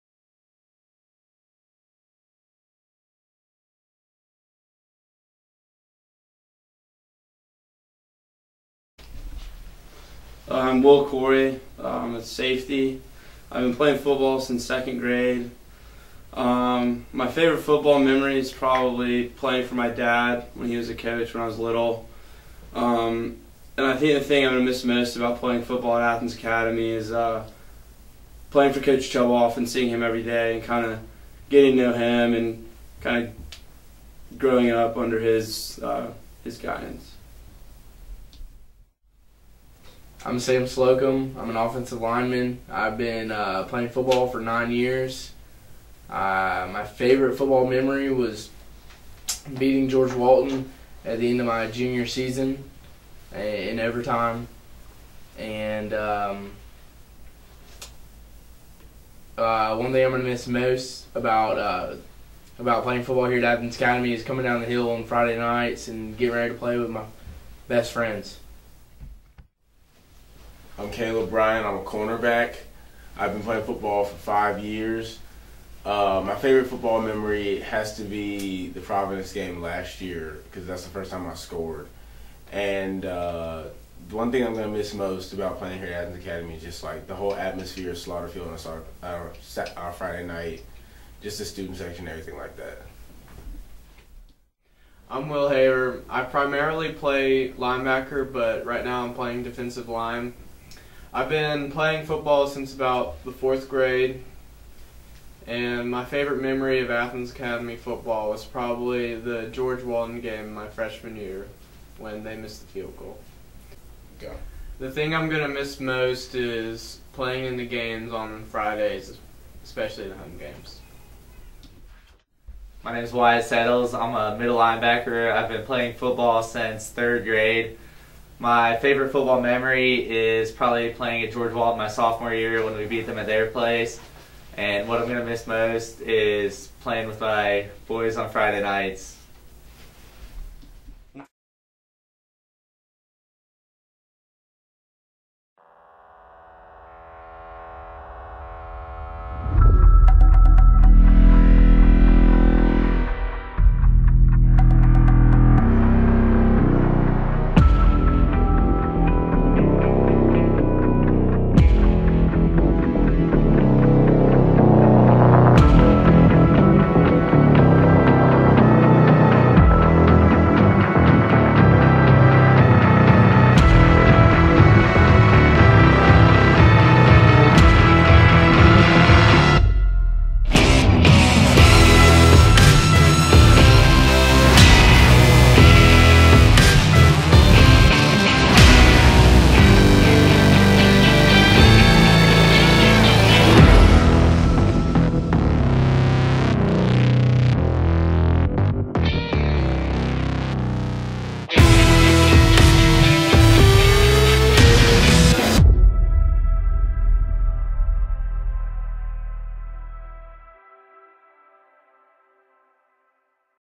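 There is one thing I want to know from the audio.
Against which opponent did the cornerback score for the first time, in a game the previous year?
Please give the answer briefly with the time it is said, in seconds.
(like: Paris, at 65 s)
Providence, at 78 s.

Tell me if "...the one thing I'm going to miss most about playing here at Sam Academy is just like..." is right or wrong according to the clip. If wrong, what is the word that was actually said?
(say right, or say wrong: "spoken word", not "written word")
wrong: "Athens", not "Sam".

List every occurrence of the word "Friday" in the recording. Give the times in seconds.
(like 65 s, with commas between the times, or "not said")
65 s, 89 s, 118 s, 138 s.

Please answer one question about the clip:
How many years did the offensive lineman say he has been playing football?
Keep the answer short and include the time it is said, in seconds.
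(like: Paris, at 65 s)
9, at 44 s.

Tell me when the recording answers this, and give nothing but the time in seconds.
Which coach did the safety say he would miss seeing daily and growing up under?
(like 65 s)
28 s.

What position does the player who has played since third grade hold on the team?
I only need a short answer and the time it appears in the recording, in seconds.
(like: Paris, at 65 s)
Middle linebacker, at 124 s.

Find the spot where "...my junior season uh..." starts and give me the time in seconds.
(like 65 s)
51 s.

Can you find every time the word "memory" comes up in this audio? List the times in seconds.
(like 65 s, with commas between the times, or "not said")
17 s, 47 s, 76 s, 106 s, 129 s.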